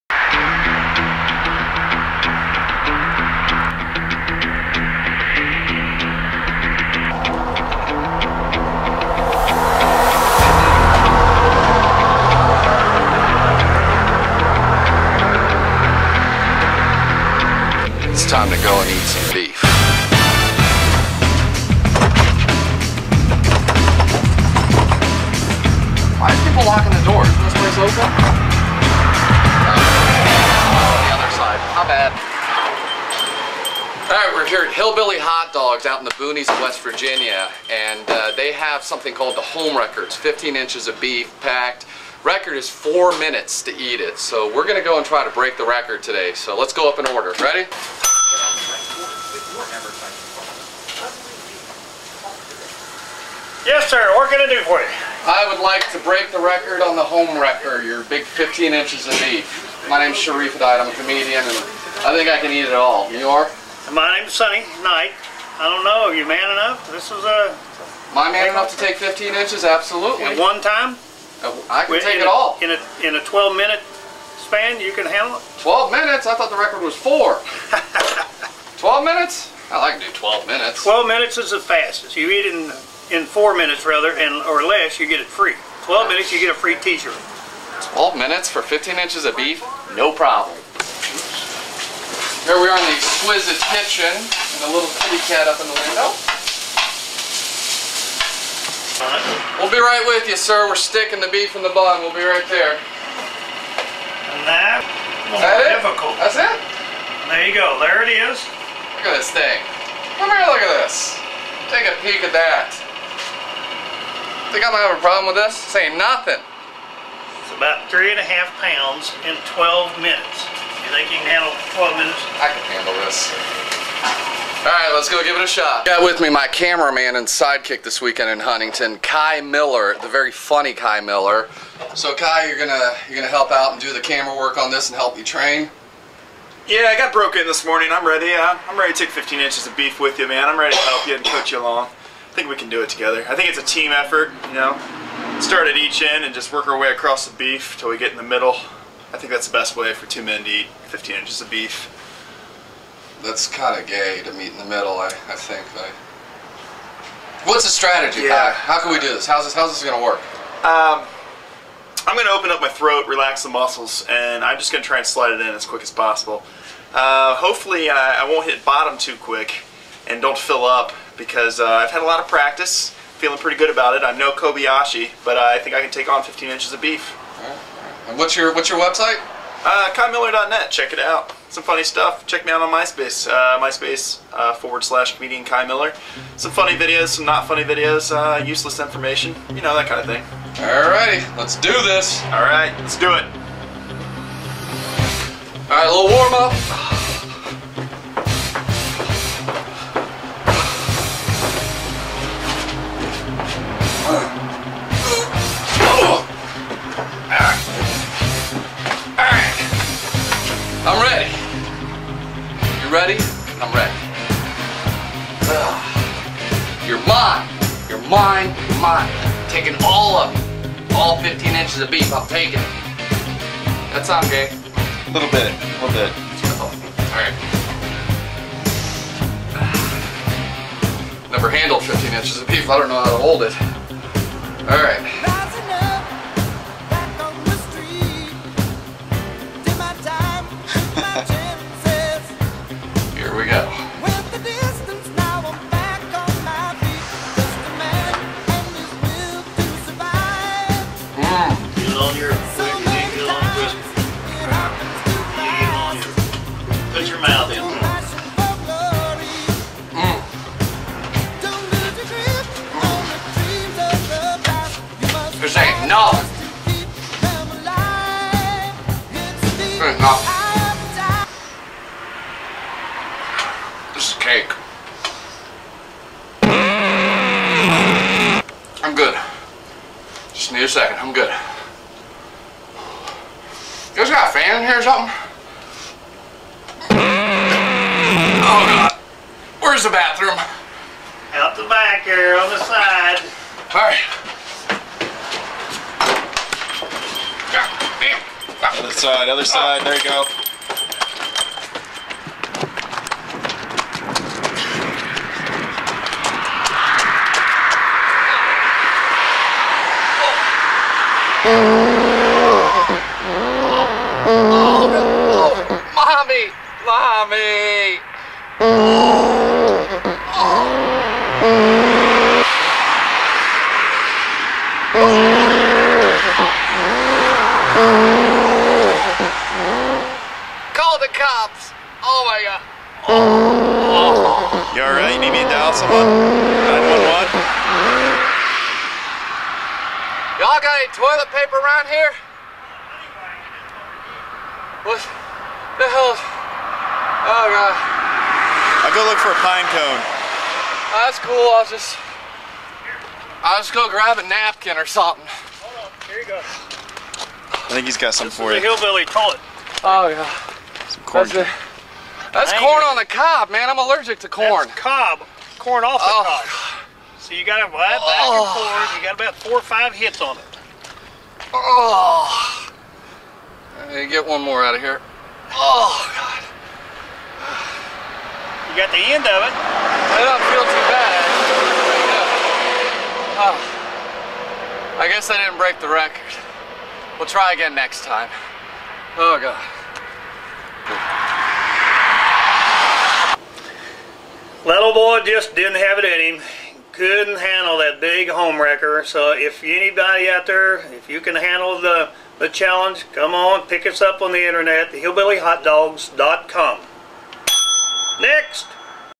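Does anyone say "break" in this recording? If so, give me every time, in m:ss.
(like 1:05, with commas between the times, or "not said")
0:45, 0:56, 6:25.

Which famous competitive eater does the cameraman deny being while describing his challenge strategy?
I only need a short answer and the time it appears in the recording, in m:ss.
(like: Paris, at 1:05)
Kobayashi, at 2:54.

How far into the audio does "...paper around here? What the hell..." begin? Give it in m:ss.
5:41.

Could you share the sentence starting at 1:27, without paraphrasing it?
12 minutes for 15 inches of beef?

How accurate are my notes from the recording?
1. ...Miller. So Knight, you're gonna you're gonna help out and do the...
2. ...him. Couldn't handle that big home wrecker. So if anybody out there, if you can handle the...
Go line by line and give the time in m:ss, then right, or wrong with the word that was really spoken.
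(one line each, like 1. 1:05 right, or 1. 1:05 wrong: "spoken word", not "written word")
1. 2:10 wrong: "Kai", not "Knight"
2. 6:36 right.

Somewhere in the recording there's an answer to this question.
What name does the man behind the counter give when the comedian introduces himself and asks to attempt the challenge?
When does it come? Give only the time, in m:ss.
1:04.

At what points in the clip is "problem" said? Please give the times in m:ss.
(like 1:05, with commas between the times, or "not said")
1:30, 1:54.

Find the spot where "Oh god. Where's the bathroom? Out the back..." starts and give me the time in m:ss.
4:48.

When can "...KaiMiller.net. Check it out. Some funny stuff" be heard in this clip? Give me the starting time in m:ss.
2:59.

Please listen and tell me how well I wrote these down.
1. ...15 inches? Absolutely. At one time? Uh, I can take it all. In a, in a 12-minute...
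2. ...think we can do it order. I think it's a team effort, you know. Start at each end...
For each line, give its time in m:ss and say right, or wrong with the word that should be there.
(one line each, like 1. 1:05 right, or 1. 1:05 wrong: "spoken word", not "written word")
1. 1:08 right
2. 2:22 wrong: "together", not "order".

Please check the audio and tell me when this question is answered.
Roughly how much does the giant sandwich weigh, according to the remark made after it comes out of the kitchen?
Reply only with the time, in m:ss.
1:57.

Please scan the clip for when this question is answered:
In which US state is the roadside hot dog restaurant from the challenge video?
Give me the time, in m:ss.
0:36.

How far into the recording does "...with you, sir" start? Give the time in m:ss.
1:40.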